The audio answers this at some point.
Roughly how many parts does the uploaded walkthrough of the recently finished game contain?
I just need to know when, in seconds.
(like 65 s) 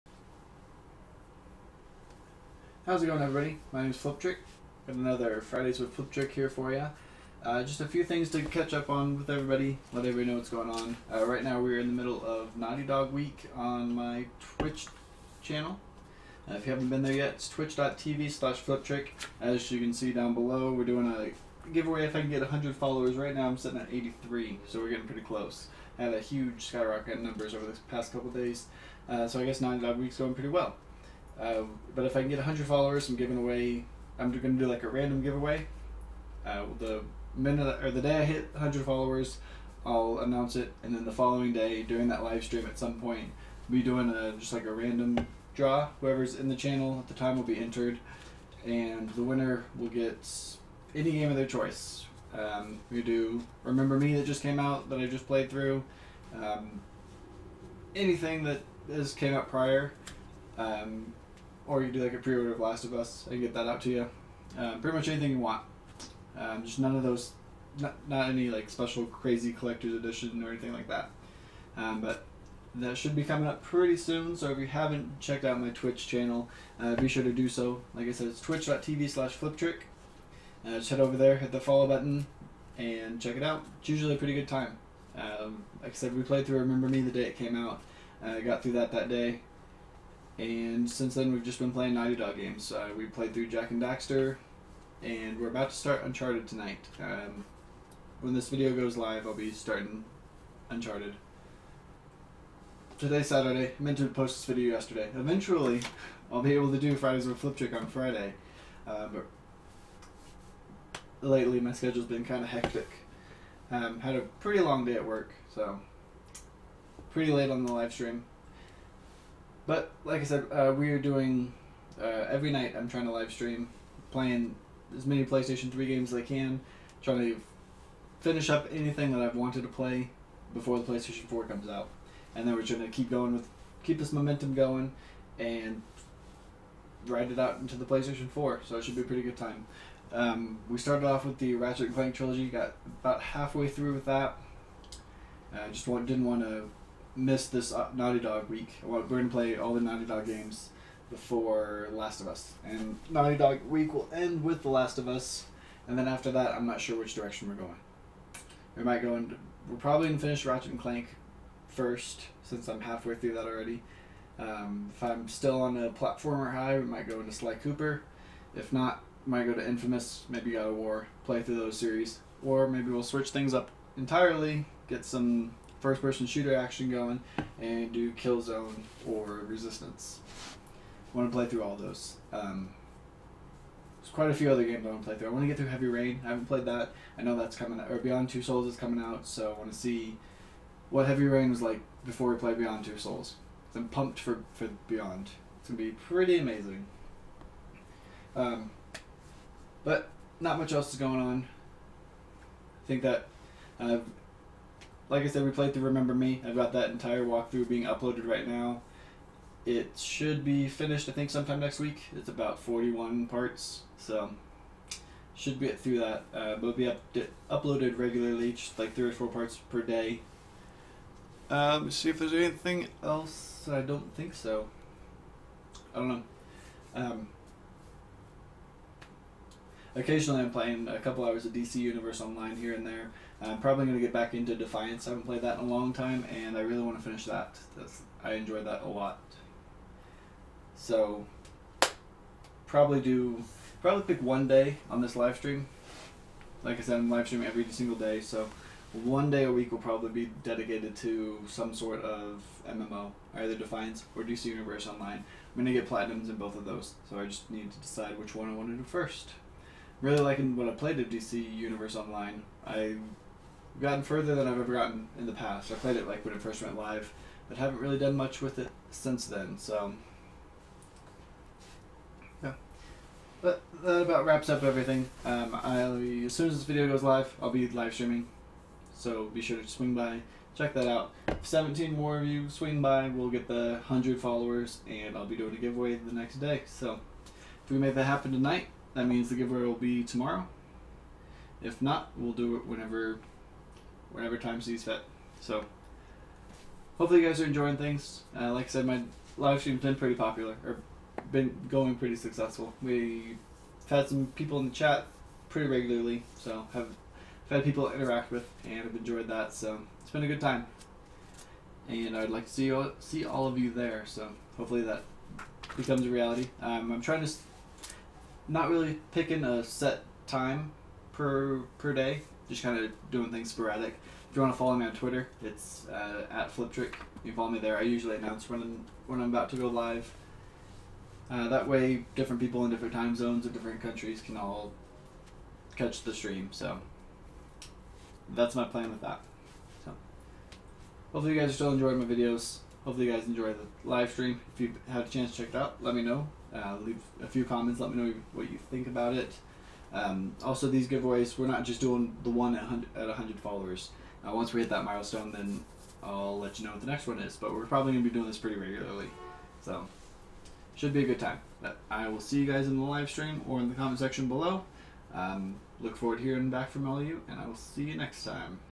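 212 s.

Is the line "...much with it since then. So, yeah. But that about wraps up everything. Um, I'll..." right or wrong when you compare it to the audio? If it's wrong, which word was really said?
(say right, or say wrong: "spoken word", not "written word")
right.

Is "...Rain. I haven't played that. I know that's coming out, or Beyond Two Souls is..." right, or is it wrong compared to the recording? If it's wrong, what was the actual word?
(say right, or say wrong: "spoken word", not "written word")
right.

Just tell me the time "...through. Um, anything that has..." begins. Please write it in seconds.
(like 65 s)
55 s.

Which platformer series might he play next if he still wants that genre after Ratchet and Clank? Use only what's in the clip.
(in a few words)
Sly Cooper.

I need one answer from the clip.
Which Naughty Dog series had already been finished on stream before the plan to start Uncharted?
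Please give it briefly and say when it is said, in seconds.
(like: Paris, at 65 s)
Jak and Daxter, at 93 s.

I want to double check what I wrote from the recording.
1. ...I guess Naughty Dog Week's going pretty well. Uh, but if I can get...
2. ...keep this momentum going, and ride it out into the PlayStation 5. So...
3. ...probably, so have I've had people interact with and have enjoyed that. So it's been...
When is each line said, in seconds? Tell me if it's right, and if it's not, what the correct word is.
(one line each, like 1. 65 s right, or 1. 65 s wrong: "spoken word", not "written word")
1. 29 s right
2. 133 s wrong: "4", not "5"
3. 305 s wrong: "regularly", not "probably".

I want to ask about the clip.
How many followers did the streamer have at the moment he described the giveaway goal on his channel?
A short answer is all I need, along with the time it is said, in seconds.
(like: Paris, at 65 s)
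83, at 23 s.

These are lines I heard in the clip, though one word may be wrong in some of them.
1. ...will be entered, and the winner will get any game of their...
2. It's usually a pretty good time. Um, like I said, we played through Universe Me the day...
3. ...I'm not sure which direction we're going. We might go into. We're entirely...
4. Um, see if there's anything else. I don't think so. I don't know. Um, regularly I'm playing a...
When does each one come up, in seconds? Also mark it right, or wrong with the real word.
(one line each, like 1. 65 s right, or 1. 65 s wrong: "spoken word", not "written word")
1. 47 s right
2. 83 s wrong: "Remember", not "Universe"
3. 156 s wrong: "probably", not "entirely"
4. 221 s wrong: "occasionally", not "regularly".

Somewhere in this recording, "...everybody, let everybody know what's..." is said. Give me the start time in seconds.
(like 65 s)
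9 s.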